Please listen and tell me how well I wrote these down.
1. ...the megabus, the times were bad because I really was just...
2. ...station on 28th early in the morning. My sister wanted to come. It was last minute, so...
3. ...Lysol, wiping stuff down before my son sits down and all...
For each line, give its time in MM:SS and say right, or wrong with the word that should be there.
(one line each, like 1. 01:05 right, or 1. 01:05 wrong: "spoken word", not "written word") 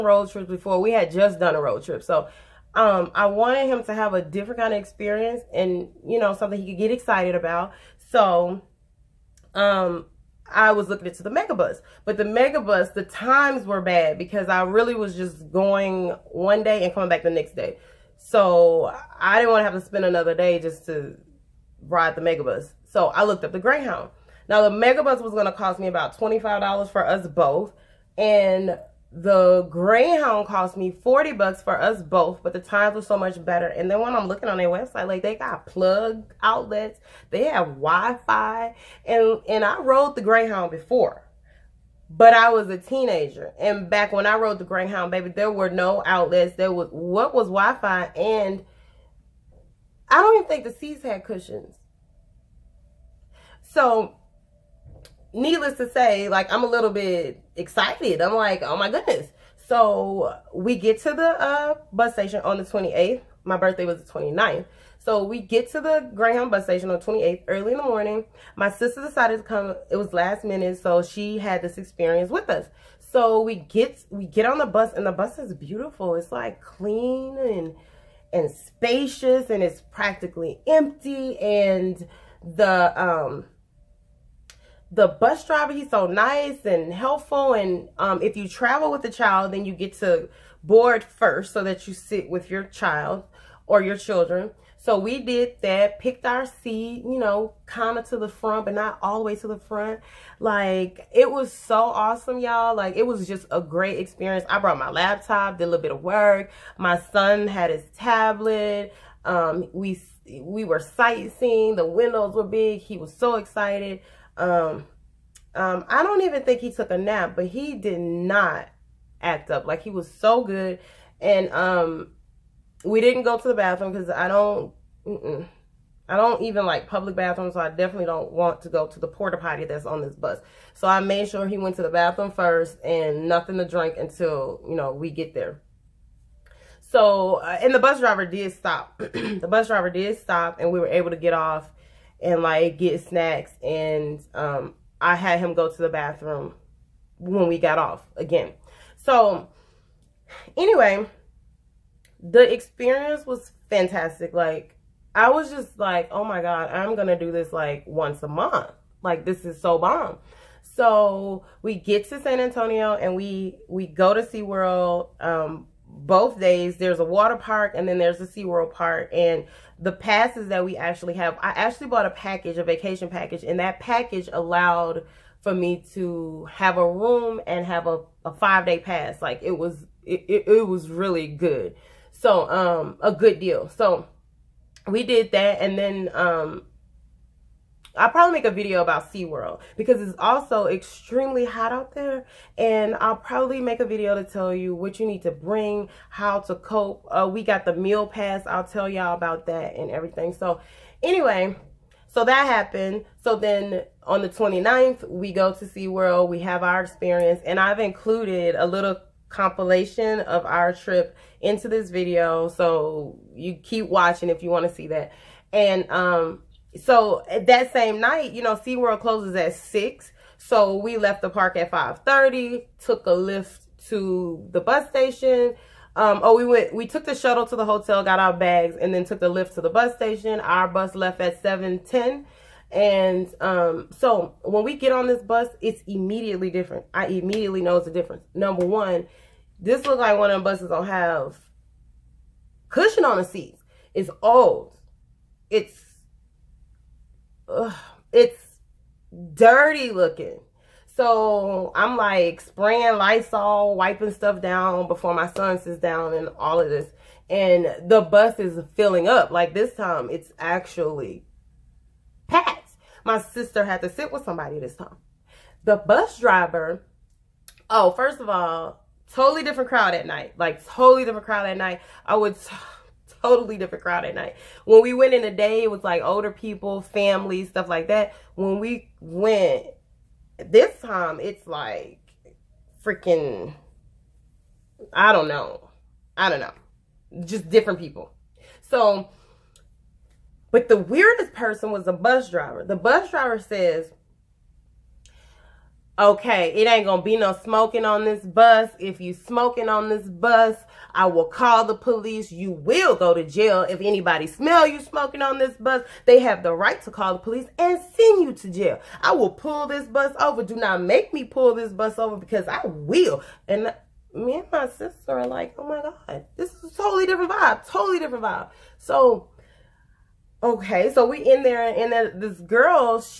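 1. 00:12 right
2. 01:06 wrong: "decided", not "wanted"
3. 04:12 right.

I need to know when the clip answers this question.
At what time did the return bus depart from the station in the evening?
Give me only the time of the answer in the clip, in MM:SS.
03:51.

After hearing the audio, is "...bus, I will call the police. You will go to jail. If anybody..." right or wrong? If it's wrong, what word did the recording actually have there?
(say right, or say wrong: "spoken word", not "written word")
right.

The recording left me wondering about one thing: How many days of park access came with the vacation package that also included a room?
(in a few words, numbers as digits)
5.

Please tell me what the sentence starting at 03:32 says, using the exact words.
So you keep watching if you want to see that.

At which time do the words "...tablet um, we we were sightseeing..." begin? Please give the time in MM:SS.
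01:47.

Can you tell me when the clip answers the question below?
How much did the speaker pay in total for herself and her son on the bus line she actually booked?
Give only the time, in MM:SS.
00:30.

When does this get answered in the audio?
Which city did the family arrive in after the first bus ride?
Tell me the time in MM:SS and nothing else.
02:42.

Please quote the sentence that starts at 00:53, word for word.
So needless to say, like I'm a little bit excited.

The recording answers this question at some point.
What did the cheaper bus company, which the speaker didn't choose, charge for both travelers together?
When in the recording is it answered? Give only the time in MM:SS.
00:26.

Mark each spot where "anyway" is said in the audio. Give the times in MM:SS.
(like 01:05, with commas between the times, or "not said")
02:30, 03:21.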